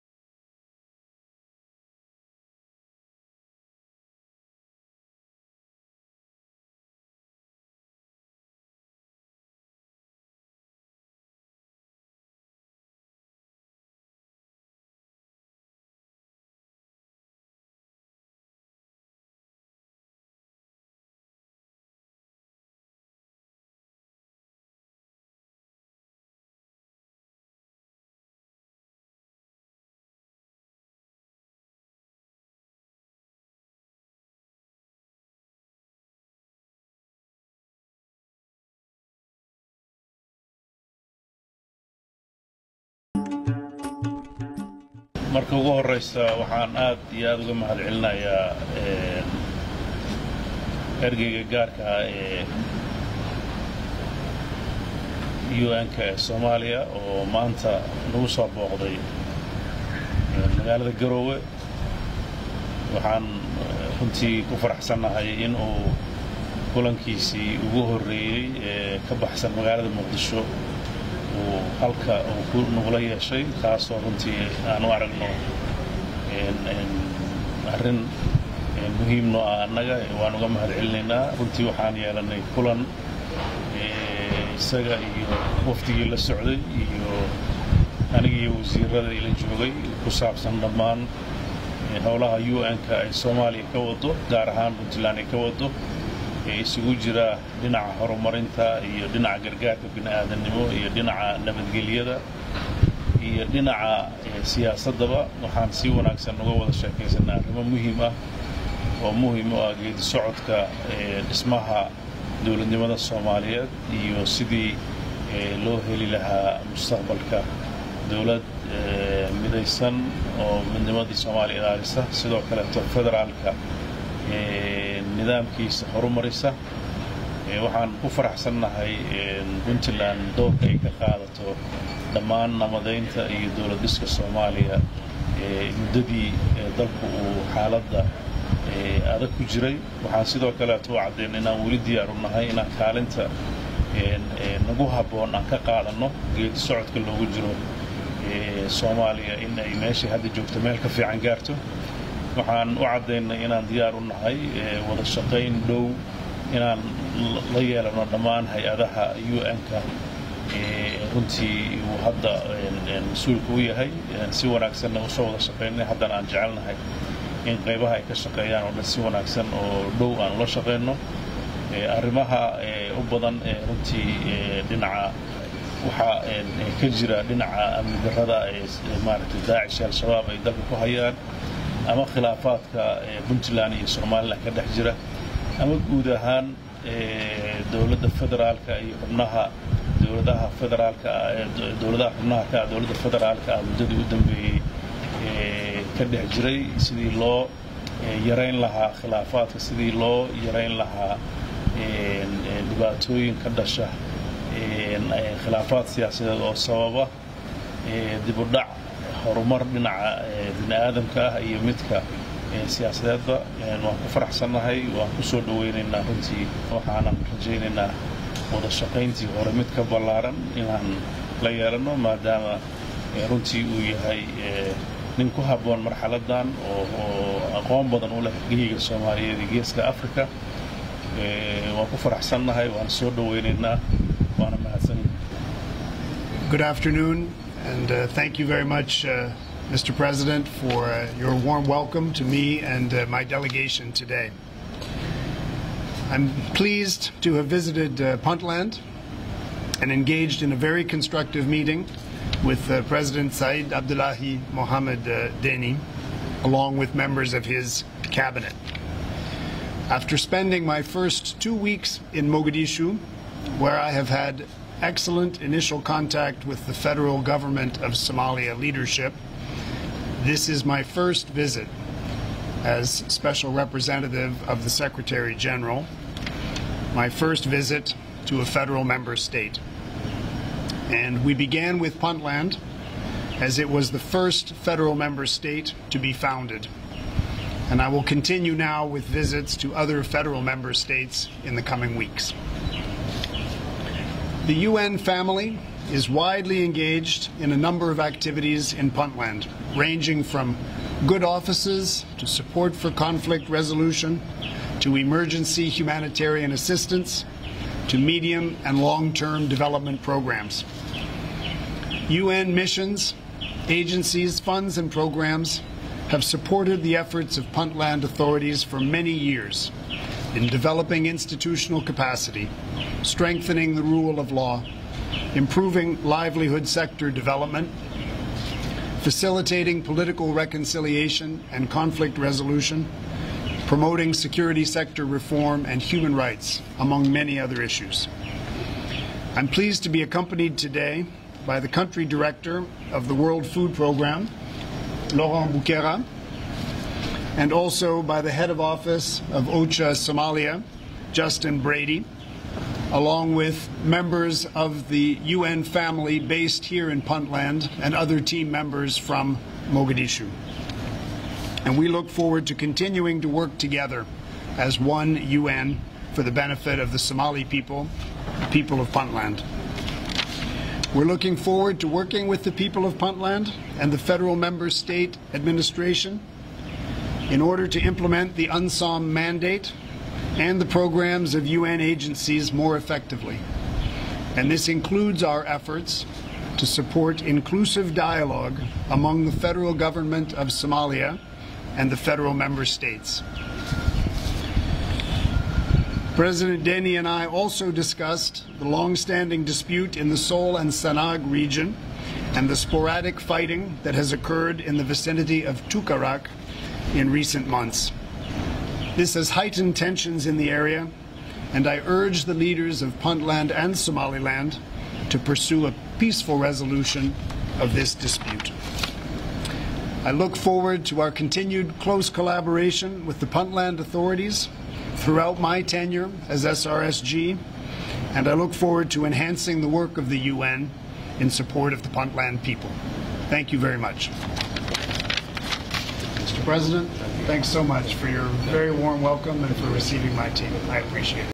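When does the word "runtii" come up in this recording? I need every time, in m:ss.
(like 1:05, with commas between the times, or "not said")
1:04, 1:14, 1:21, 2:41, 2:53, 3:36, 3:43.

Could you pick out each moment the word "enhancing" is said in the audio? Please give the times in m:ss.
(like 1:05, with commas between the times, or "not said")
7:09.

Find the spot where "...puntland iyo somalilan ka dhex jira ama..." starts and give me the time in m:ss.
3:03.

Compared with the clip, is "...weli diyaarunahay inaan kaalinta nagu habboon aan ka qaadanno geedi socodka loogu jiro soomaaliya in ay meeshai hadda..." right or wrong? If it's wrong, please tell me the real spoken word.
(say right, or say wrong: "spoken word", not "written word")
right.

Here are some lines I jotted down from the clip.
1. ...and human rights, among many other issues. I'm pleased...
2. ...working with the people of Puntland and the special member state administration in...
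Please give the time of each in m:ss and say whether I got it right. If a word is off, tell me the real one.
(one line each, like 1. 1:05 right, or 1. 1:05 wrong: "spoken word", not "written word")
1. 5:35 right
2. 6:11 wrong: "federal", not "special".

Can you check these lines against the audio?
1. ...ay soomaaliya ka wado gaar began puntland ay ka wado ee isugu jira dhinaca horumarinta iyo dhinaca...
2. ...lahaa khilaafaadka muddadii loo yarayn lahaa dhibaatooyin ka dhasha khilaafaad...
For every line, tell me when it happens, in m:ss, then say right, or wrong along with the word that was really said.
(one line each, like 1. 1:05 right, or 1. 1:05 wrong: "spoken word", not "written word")
1. 1:33 wrong: "ahaan", not "began"
2. 3:18 wrong: "sidii", not "muddadii".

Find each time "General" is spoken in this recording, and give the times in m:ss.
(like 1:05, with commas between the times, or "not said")
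4:35.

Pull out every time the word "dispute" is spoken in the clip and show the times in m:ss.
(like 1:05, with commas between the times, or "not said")
6:39, 6:57.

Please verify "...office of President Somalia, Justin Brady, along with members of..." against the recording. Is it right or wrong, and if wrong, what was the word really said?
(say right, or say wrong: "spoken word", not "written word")
wrong: "OCHA", not "President".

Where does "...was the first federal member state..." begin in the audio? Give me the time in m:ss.
4:43.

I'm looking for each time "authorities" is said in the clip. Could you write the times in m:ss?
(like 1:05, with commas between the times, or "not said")
5:18, 7:03.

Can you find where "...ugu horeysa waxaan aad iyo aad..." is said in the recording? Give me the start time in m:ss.
0:45.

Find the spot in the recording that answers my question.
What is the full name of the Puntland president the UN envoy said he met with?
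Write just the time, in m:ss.
4:13.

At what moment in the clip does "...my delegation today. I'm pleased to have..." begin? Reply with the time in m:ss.
4:03.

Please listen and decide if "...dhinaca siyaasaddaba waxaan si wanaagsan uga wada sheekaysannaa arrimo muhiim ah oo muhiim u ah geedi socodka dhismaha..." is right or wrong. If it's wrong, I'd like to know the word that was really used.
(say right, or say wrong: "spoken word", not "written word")
right.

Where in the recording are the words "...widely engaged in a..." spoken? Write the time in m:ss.
4:56.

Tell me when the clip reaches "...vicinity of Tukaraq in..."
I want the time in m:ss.
6:44.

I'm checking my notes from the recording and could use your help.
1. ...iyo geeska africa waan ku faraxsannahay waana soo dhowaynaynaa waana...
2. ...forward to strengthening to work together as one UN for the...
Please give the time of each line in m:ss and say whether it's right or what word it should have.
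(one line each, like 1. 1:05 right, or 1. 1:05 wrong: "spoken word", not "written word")
1. 3:49 right
2. 6:02 wrong: "continuing", not "strengthening".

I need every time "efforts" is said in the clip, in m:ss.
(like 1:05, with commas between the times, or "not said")
5:16, 6:25.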